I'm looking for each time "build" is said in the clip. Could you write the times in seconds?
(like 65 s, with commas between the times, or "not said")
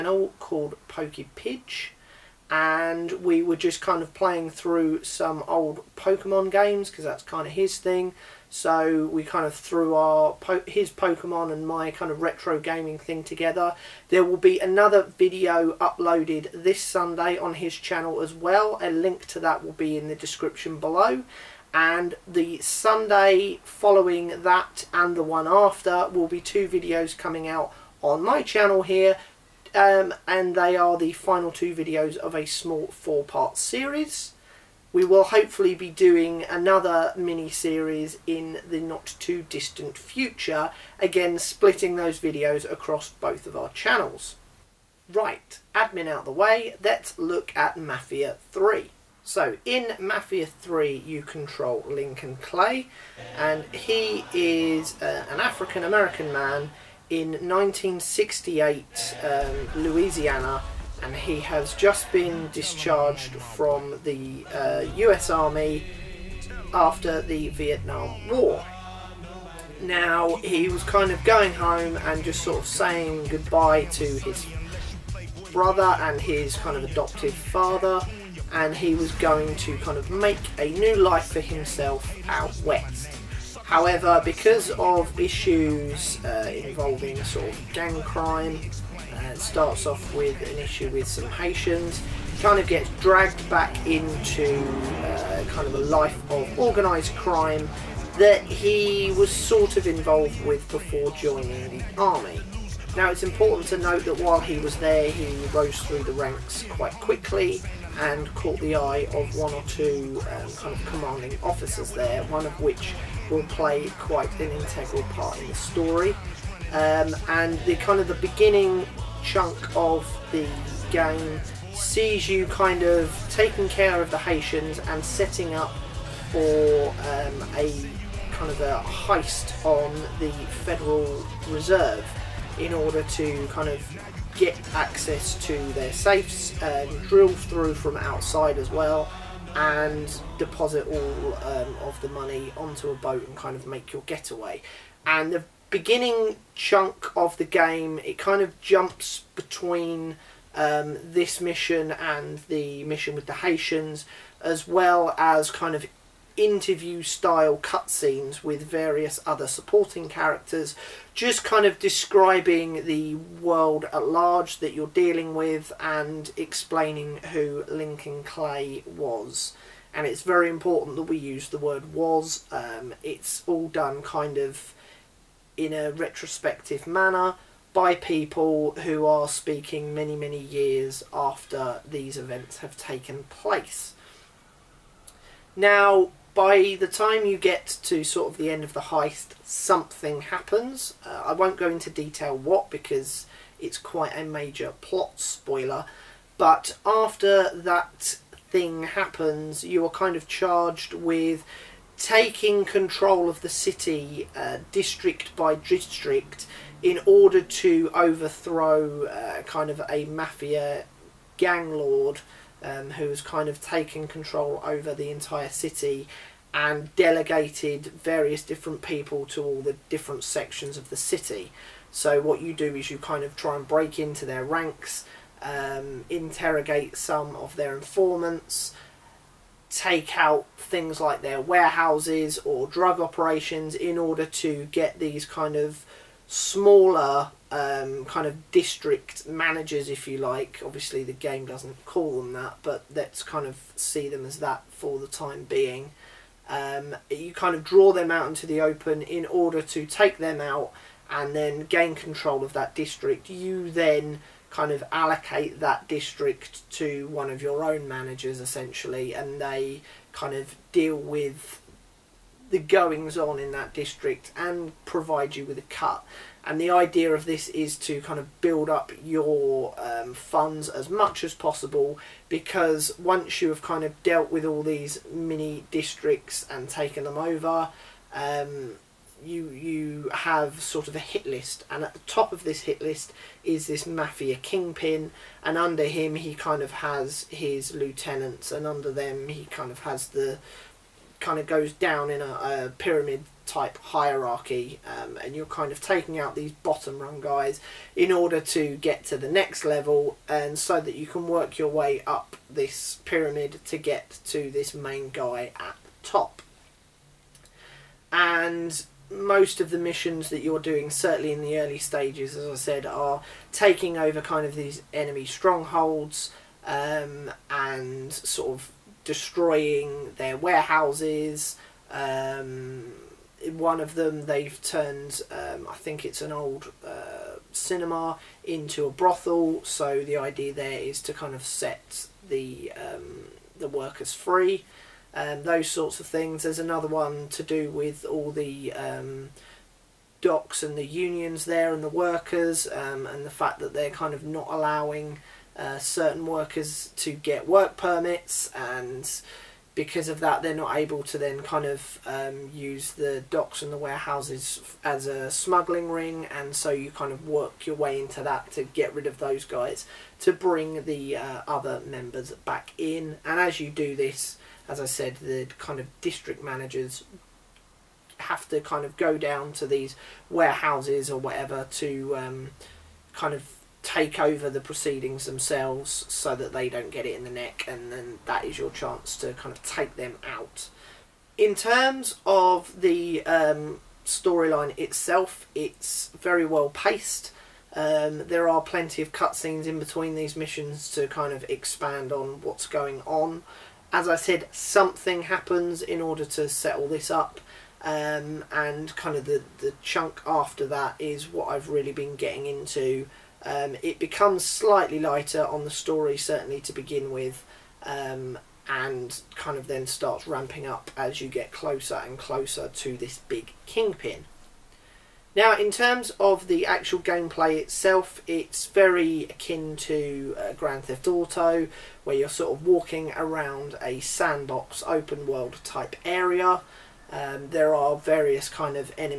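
268 s.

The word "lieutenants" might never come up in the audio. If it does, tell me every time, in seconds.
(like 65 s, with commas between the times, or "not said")
287 s.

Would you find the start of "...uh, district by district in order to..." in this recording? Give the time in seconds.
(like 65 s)
204 s.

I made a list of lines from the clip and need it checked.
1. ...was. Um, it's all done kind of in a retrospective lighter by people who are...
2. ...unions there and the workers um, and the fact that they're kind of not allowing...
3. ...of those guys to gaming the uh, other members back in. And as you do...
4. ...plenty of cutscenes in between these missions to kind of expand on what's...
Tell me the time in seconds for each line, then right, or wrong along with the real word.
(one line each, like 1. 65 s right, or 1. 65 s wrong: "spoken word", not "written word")
1. 171 s wrong: "manner", not "lighter"
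2. 340 s right
3. 359 s wrong: "bring", not "gaming"
4. 388 s right.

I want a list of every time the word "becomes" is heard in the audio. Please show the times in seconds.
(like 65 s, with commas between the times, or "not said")
403 s.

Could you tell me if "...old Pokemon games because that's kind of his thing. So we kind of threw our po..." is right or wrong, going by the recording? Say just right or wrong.
right.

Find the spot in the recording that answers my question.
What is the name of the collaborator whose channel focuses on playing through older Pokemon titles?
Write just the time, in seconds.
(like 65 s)
0 s.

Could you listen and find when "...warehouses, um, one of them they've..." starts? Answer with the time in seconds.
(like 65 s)
320 s.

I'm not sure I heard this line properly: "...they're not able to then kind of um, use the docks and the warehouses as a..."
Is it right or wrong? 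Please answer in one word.
right.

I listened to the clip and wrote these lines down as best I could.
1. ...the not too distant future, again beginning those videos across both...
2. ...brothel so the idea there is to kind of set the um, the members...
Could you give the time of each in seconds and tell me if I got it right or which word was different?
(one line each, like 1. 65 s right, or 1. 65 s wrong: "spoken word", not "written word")
1. 38 s wrong: "splitting", not "beginning"
2. 328 s wrong: "workers", not "members".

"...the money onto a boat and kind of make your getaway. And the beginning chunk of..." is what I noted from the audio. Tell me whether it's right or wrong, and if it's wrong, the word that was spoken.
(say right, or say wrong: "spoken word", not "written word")
right.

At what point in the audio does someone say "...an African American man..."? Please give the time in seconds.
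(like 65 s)
55 s.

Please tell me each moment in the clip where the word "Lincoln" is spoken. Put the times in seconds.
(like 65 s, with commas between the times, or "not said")
51 s, 167 s.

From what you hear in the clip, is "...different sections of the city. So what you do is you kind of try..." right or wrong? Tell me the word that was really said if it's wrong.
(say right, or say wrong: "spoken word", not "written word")
right.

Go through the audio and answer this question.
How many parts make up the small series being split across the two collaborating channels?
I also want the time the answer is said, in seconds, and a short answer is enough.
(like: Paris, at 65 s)
4, at 32 s.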